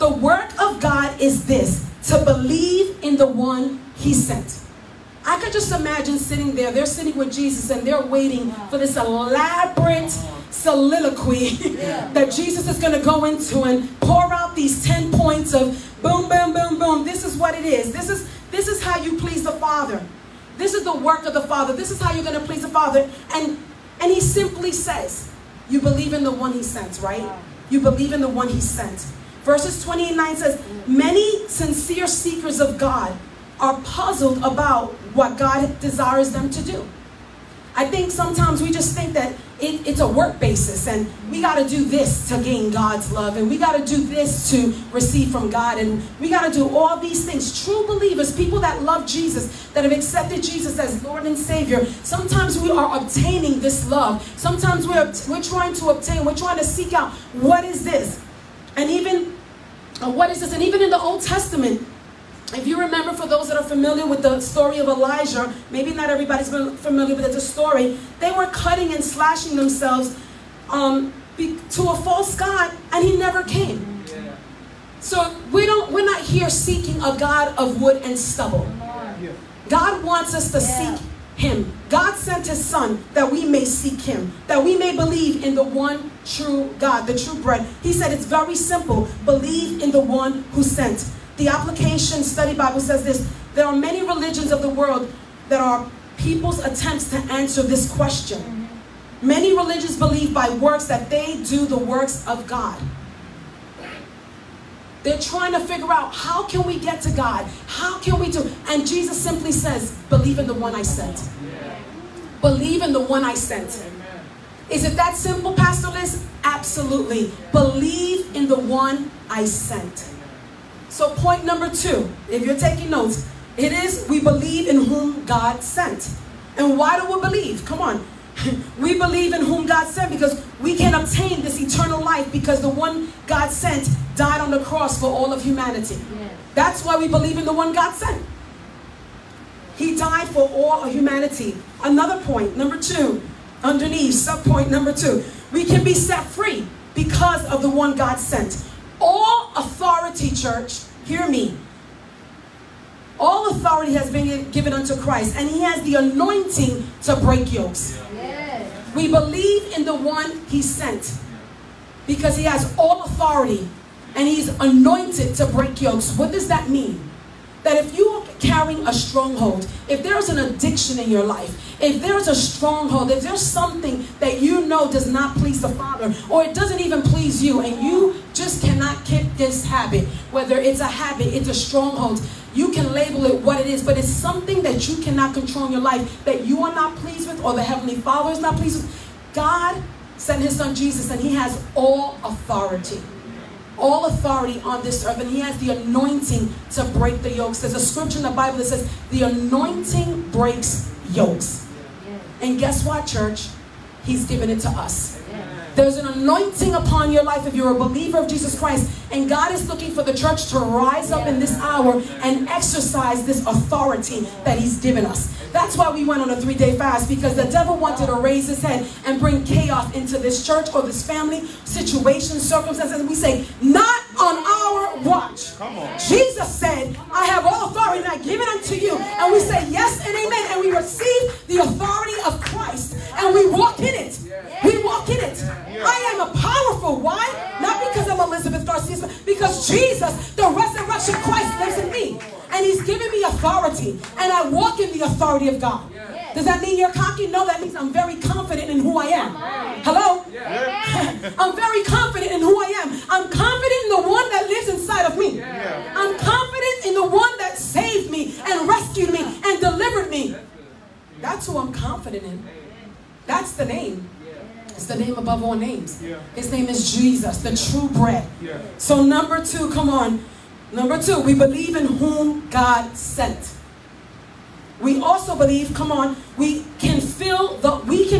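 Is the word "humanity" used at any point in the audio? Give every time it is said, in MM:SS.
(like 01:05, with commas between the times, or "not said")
02:15, 02:20.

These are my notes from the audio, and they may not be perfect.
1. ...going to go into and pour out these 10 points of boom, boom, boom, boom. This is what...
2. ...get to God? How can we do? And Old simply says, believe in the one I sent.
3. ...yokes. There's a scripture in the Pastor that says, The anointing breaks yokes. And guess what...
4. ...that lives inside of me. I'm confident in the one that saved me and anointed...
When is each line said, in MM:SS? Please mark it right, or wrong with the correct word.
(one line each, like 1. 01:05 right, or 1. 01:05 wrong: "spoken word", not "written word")
1. 00:12 right
2. 01:46 wrong: "Jesus", not "Old"
3. 03:17 wrong: "Bible", not "Pastor"
4. 04:14 wrong: "rescued", not "anointed".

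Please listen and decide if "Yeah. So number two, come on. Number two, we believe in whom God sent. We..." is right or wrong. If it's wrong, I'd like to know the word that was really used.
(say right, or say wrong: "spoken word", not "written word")
right.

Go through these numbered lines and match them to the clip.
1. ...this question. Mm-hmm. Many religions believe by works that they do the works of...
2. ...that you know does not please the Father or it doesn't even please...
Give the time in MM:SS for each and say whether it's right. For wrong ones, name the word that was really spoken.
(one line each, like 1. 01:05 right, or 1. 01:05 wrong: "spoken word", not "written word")
1. 01:37 right
2. 02:54 right.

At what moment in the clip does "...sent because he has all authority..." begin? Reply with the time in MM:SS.
02:40.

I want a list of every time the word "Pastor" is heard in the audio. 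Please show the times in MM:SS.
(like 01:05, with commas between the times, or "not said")
01:55.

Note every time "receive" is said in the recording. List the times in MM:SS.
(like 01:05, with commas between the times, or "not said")
00:44, 03:50.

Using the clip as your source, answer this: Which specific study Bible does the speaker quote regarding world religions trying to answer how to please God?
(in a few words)
The Application Study Bible.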